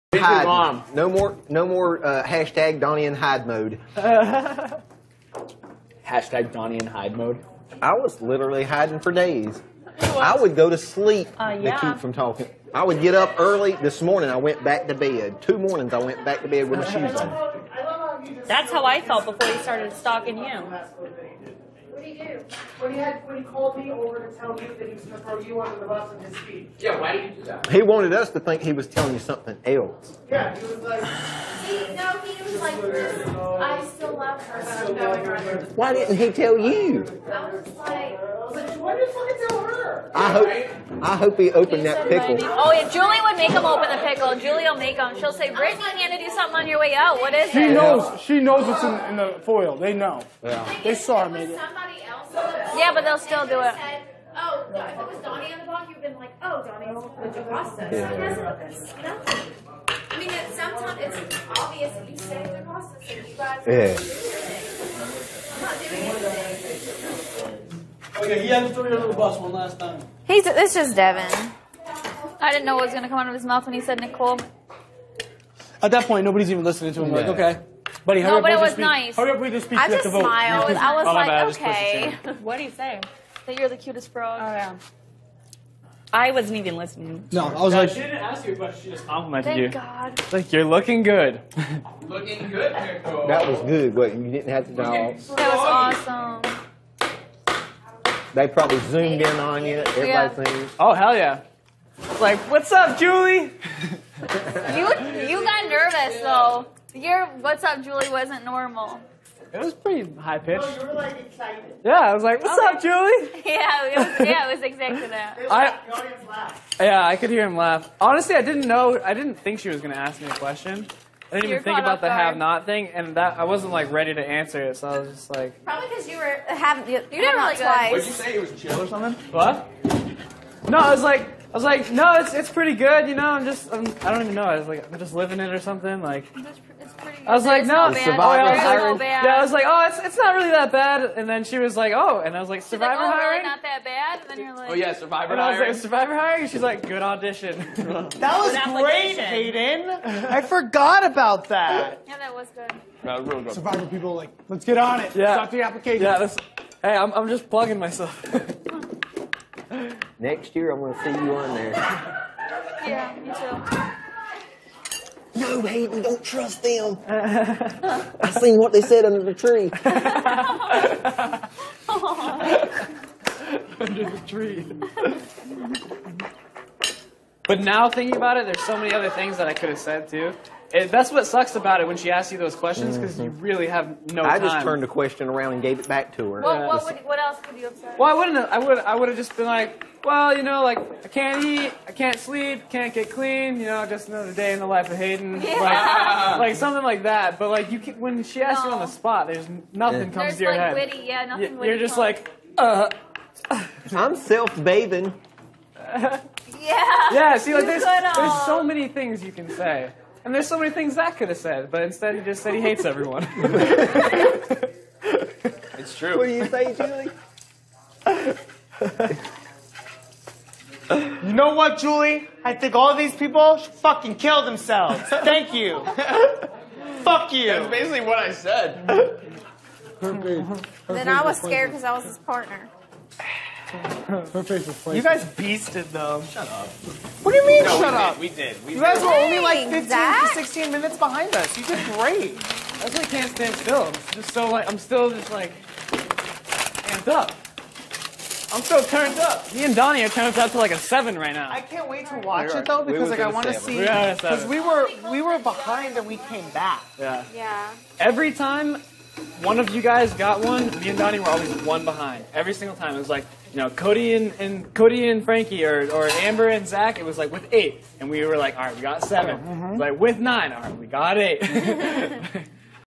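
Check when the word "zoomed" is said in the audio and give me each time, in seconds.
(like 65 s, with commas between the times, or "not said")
98 s.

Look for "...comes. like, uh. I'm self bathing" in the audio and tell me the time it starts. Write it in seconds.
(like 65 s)
201 s.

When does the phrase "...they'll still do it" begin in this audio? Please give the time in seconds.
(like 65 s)
53 s.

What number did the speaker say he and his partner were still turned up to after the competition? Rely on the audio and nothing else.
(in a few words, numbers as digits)
7.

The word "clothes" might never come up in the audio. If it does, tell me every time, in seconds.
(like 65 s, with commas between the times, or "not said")
not said.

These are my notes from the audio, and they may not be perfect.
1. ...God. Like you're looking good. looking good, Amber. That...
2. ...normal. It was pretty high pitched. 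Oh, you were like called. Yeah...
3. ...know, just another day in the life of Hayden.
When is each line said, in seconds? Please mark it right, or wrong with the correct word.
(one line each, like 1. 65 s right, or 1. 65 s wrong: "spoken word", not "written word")
1. 90 s wrong: "Nicole", not "Amber"
2. 108 s wrong: "excited", not "called"
3. 193 s right.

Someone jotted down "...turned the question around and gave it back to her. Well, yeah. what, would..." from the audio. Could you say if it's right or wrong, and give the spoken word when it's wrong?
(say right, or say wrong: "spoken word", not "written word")
right.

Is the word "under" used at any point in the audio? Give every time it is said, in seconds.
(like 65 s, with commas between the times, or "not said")
25 s, 35 s, 169 s, 173 s.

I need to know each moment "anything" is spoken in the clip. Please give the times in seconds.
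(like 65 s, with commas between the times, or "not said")
66 s.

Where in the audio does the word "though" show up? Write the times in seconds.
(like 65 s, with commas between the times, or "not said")
106 s, 252 s.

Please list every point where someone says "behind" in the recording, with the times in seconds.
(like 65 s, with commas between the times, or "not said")
240 s, 255 s, 261 s.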